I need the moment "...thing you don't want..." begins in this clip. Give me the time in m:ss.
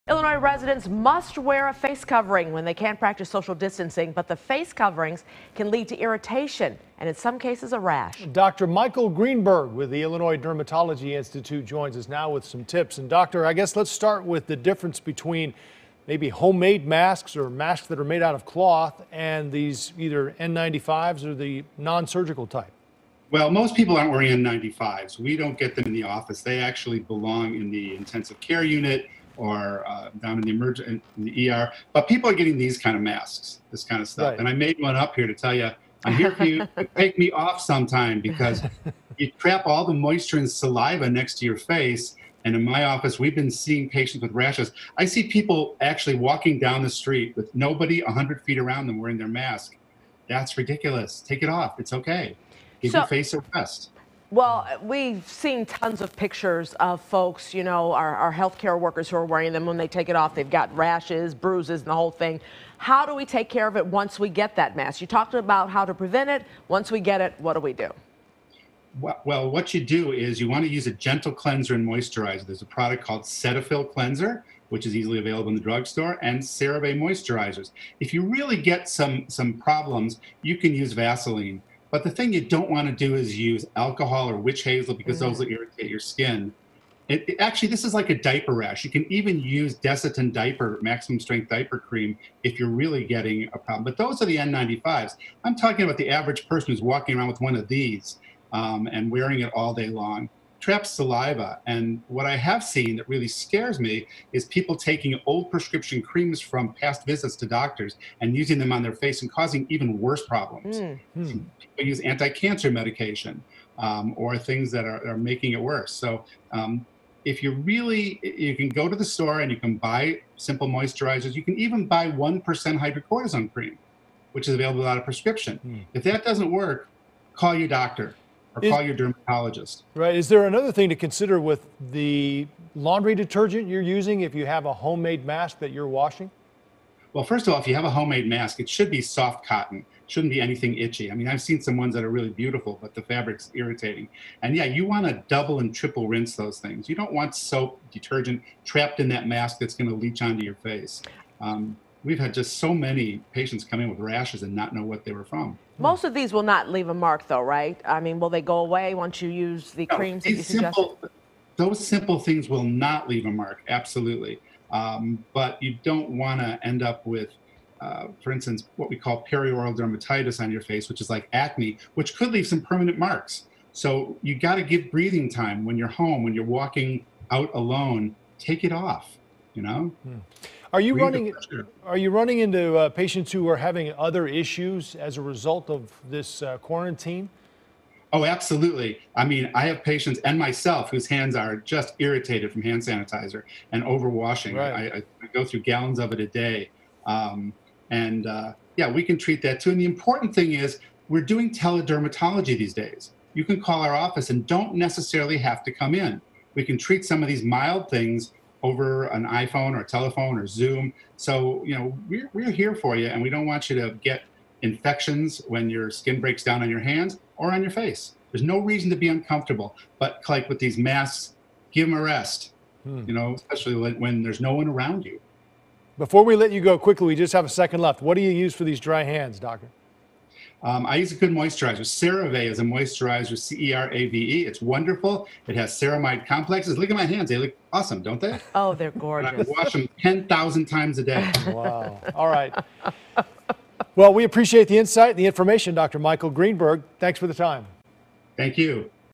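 1:22.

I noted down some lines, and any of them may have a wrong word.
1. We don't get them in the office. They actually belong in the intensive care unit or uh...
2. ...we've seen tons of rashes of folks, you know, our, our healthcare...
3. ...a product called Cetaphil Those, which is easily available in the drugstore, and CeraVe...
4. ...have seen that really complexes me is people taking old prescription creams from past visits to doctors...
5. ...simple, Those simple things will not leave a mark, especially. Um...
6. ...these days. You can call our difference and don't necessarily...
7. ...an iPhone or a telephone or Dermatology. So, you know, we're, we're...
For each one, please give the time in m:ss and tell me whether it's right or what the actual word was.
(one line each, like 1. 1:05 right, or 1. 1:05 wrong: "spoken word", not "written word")
1. 0:25 right
2. 0:54 wrong: "pictures", not "rashes"
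3. 1:12 wrong: "Cleanser", not "Those"
4. 1:42 wrong: "scares", not "complexes"
5. 2:40 wrong: "absolutely", not "especially"
6. 3:22 wrong: "office", not "difference"
7. 3:29 wrong: "Zoom", not "Dermatology".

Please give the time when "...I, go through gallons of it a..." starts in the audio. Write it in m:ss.
3:14.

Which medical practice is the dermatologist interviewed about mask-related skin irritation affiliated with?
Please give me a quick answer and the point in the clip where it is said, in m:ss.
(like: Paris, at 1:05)
Illinois Dermatology Institute, at 0:10.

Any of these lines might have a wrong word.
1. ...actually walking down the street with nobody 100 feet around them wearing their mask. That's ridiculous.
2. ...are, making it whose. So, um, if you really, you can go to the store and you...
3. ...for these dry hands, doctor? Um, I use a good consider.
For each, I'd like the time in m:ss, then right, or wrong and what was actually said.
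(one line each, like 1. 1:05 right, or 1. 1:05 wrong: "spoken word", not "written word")
1. 0:45 right
2. 1:55 wrong: "worse", not "whose"
3. 3:48 wrong: "moisturizer", not "consider".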